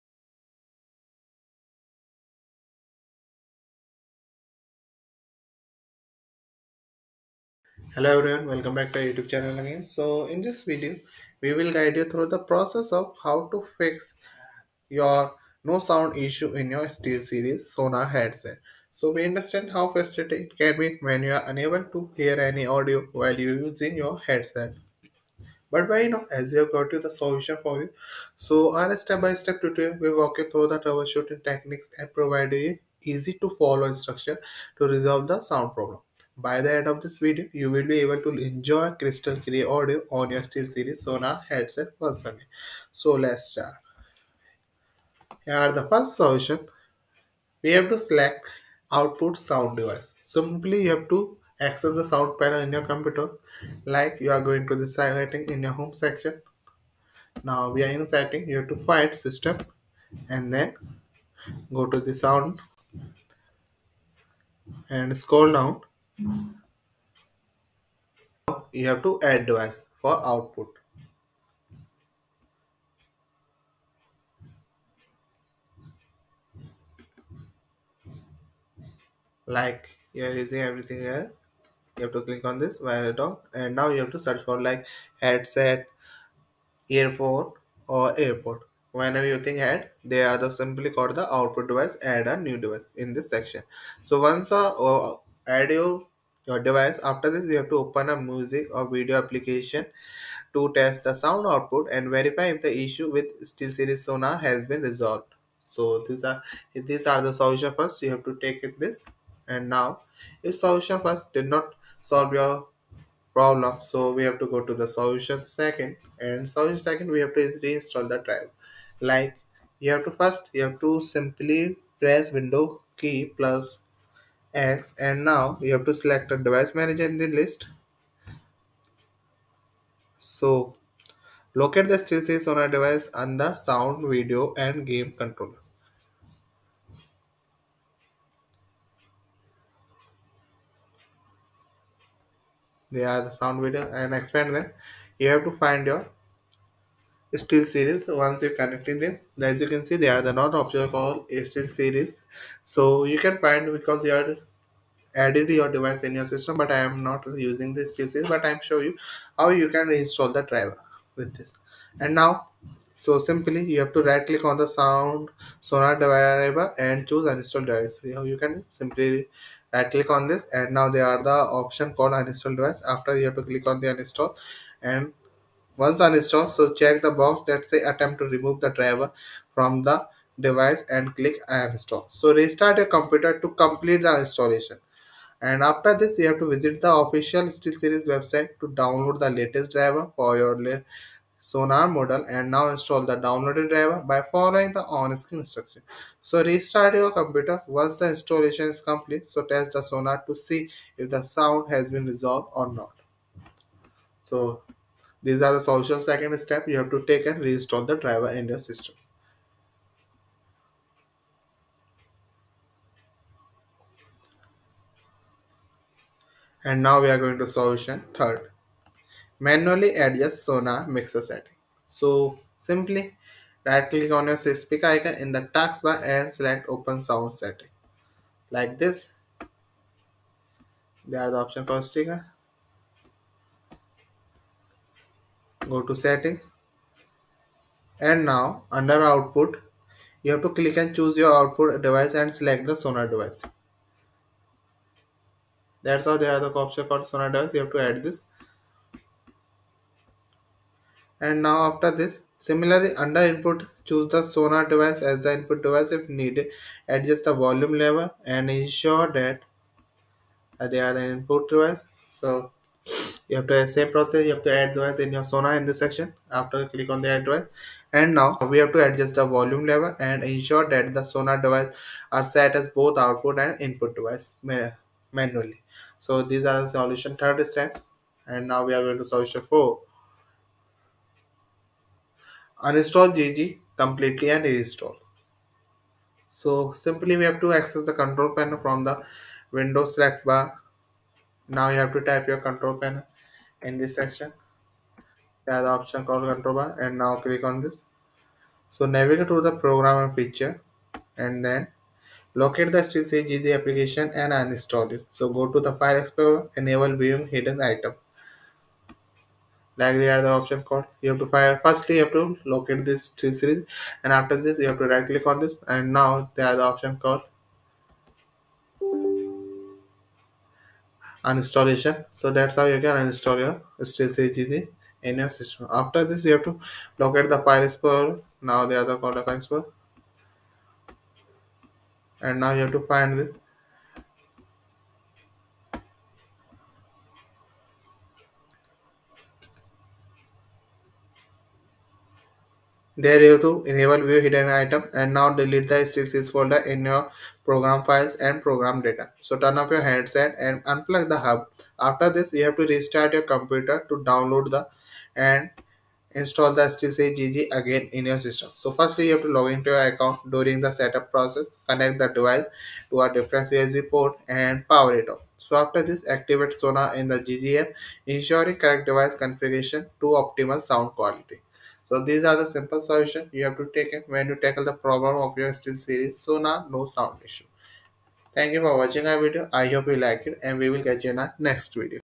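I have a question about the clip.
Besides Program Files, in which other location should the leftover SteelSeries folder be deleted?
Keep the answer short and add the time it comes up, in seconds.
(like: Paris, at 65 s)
Program Data, at 348 s.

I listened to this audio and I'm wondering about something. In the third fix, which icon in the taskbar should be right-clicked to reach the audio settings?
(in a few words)
Speaker icon.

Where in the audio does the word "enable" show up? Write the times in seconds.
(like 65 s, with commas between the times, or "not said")
306 s, 343 s.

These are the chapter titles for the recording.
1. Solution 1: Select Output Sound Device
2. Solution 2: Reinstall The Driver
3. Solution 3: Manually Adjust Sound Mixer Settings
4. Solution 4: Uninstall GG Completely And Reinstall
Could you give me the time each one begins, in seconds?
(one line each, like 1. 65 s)
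1. 46 s
2. 117 s
3. 220 s
4. 280 s.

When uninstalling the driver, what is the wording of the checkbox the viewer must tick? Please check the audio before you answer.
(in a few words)
Attempt to remove the driver.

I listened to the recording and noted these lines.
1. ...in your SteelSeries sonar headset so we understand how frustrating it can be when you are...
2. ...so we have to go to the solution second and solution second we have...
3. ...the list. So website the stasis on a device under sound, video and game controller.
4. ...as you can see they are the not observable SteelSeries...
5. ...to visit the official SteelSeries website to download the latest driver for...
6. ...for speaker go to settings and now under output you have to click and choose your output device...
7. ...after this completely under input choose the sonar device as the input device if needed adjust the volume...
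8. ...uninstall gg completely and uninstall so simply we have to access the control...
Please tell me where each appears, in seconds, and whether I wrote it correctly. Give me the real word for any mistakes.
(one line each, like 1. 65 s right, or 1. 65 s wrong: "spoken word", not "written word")
1. 16 s right
2. 113 s right
3. 127 s wrong: "locate", not "website"
4. 149 s right
5. 186 s right
6. 231 s right
7. 251 s wrong: "similarly", not "completely"
8. 282 s wrong: "reinstall", not "uninstall".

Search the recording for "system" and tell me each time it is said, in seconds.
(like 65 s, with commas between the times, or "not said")
59 s, 156 s, 208 s, 325 s, 358 s.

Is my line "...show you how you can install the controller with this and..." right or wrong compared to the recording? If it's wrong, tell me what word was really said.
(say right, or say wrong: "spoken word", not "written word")
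wrong: "driver", not "controller".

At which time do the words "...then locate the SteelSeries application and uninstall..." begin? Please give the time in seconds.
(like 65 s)
301 s.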